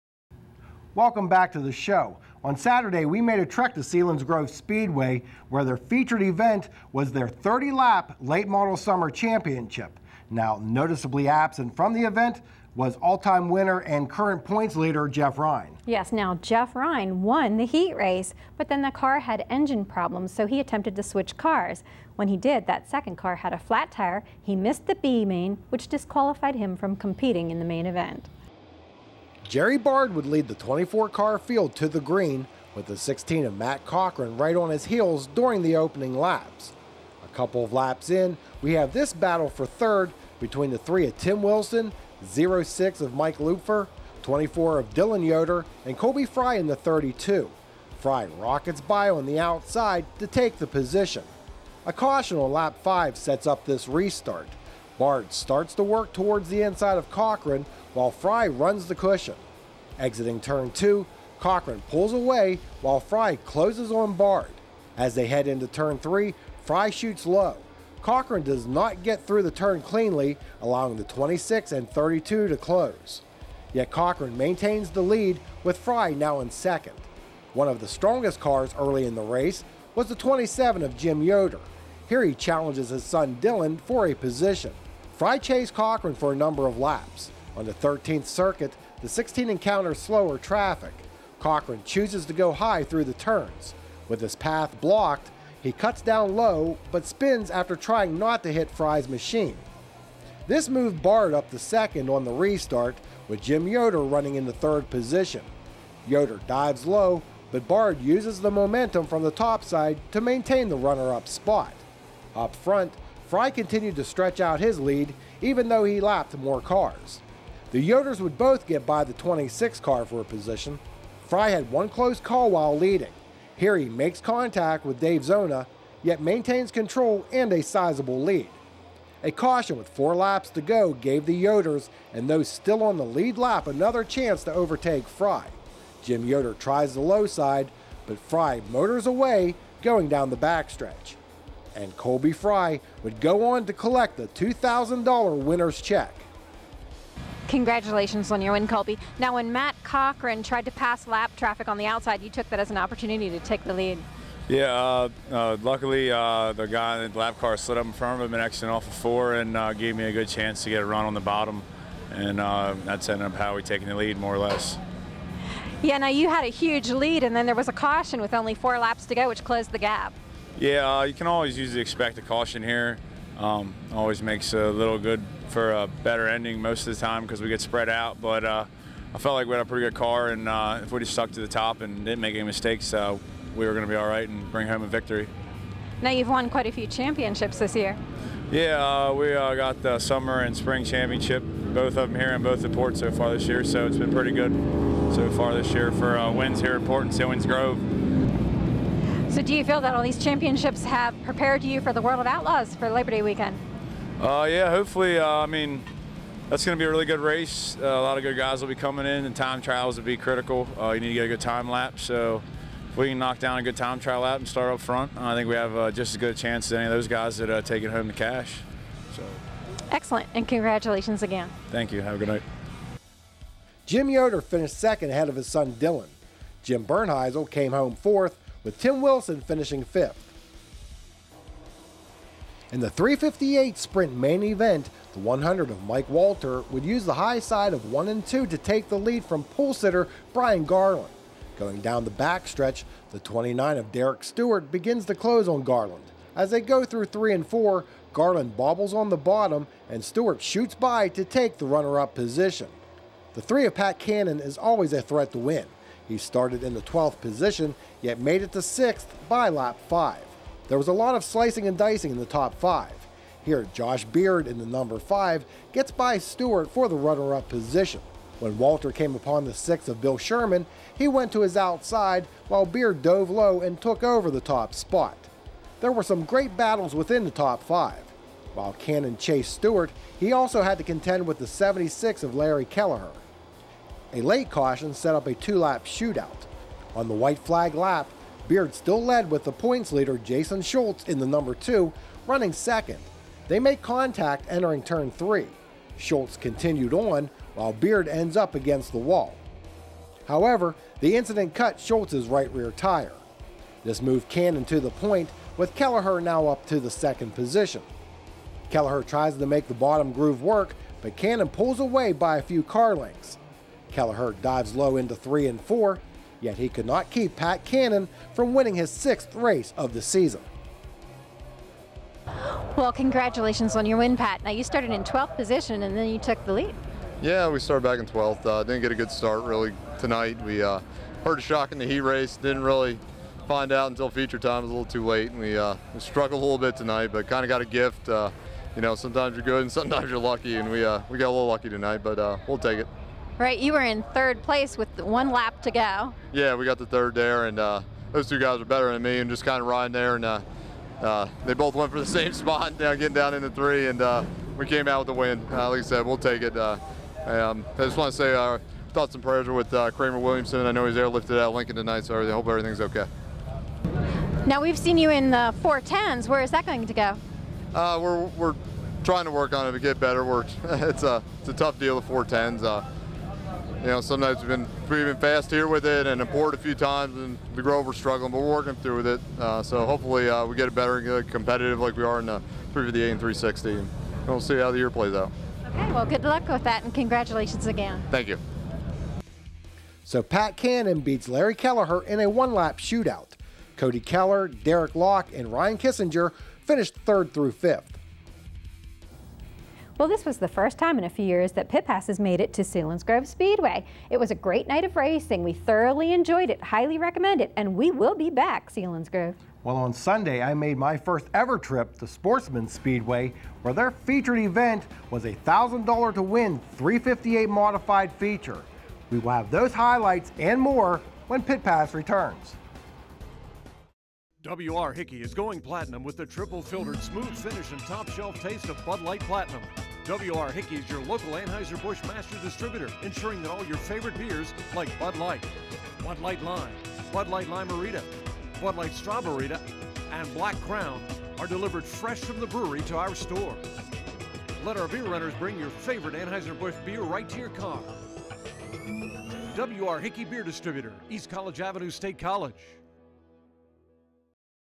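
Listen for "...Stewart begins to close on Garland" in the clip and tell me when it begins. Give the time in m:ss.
4:04.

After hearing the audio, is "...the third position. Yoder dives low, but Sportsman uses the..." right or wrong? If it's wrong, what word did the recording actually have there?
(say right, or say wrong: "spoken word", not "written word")
wrong: "Bard", not "Sportsman".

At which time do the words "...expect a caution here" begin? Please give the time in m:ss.
2:51.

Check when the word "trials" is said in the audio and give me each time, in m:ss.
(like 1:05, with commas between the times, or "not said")
3:29, 3:33.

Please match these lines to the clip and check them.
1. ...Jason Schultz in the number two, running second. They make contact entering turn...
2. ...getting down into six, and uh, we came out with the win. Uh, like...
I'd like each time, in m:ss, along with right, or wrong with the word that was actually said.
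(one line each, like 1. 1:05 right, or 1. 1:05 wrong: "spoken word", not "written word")
1. 4:50 right
2. 5:52 wrong: "three", not "six".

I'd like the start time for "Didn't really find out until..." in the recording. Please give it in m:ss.
5:32.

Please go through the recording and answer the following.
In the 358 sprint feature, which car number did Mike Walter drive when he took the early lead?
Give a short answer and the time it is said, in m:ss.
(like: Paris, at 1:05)
100, at 3:55.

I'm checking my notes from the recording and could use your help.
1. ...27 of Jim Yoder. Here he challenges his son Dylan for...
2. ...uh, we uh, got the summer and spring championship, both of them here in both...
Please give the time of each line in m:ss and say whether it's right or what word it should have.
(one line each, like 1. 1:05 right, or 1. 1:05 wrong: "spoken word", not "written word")
1. 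1:20 right
2. 3:09 right.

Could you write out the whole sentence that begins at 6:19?
Uh, so hopefully uh, we get it better and get competitive like we are in the 358 and 360.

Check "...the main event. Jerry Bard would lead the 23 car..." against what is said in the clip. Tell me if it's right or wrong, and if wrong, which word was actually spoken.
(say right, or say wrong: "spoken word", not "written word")
wrong: "24", not "23".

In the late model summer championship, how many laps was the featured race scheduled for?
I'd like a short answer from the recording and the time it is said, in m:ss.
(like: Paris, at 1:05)
30, at 0:07.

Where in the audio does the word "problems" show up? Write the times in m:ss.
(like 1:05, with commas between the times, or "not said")
0:19.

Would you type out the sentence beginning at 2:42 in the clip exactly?
And uh, that's ended up how we taking the lead, more or less.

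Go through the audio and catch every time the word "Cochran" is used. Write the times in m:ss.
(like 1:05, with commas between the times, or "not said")
0:33, 0:57, 1:01, 1:08, 1:13, 1:25, 1:31, 2:29.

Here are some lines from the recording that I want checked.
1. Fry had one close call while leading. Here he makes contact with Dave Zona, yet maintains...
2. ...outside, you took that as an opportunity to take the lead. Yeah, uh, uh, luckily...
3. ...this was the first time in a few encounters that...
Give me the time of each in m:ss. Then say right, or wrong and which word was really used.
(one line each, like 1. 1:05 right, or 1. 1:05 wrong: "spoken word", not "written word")
1. 2:01 right
2. 2:31 right
3. 6:40 wrong: "years", not "encounters".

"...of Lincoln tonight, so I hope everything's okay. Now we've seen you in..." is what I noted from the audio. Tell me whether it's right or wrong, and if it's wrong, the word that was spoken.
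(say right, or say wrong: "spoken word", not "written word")
right.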